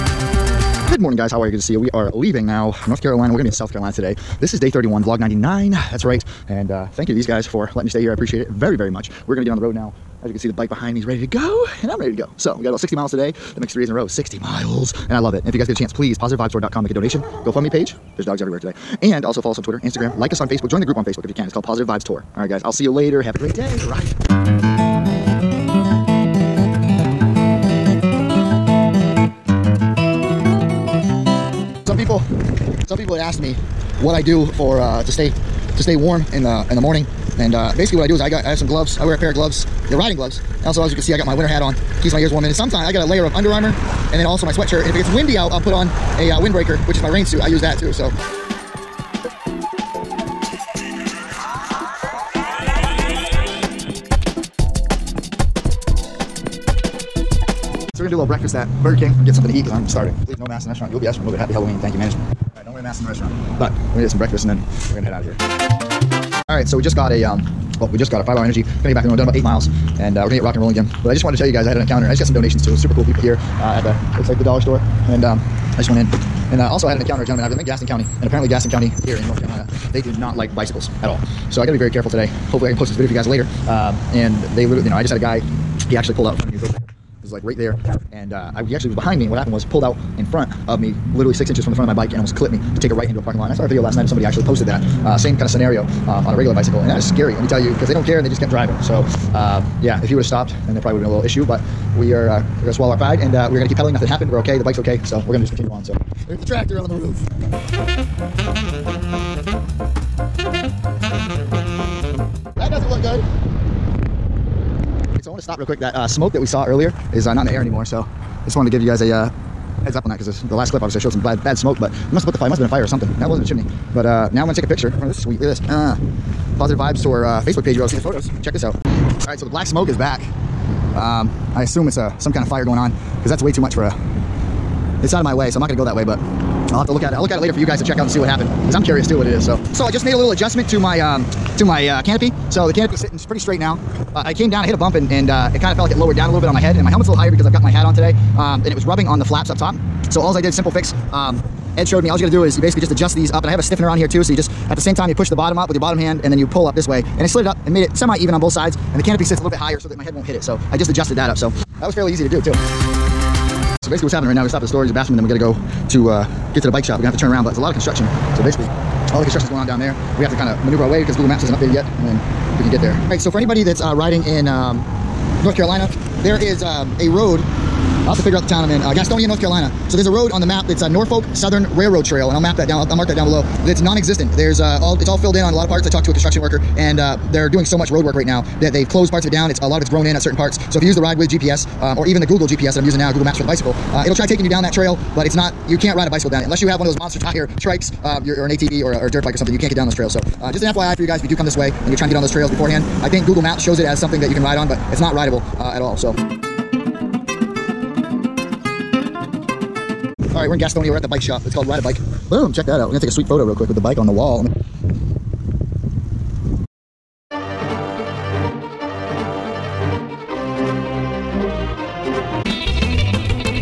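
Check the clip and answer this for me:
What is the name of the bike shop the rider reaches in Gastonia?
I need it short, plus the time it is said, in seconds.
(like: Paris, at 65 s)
Ride a Bike, at 211 s.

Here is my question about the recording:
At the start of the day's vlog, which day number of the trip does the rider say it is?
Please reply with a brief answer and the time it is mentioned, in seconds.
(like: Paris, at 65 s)
31, at 4 s.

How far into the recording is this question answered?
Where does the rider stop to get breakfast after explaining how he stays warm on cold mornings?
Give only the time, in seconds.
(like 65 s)
58 s.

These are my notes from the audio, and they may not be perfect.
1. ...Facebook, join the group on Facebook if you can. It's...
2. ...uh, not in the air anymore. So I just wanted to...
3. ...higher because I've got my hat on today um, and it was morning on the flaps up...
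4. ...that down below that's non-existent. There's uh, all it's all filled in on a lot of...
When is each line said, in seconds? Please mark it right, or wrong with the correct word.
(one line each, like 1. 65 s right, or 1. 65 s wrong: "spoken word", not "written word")
1. 20 s right
2. 117 s right
3. 147 s wrong: "rubbing", not "morning"
4. 183 s right.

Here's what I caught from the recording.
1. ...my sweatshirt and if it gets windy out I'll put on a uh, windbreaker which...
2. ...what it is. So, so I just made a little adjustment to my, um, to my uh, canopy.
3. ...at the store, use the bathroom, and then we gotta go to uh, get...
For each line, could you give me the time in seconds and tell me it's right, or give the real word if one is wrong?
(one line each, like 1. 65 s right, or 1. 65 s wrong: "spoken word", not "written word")
1. 44 s right
2. 139 s right
3. 164 s right.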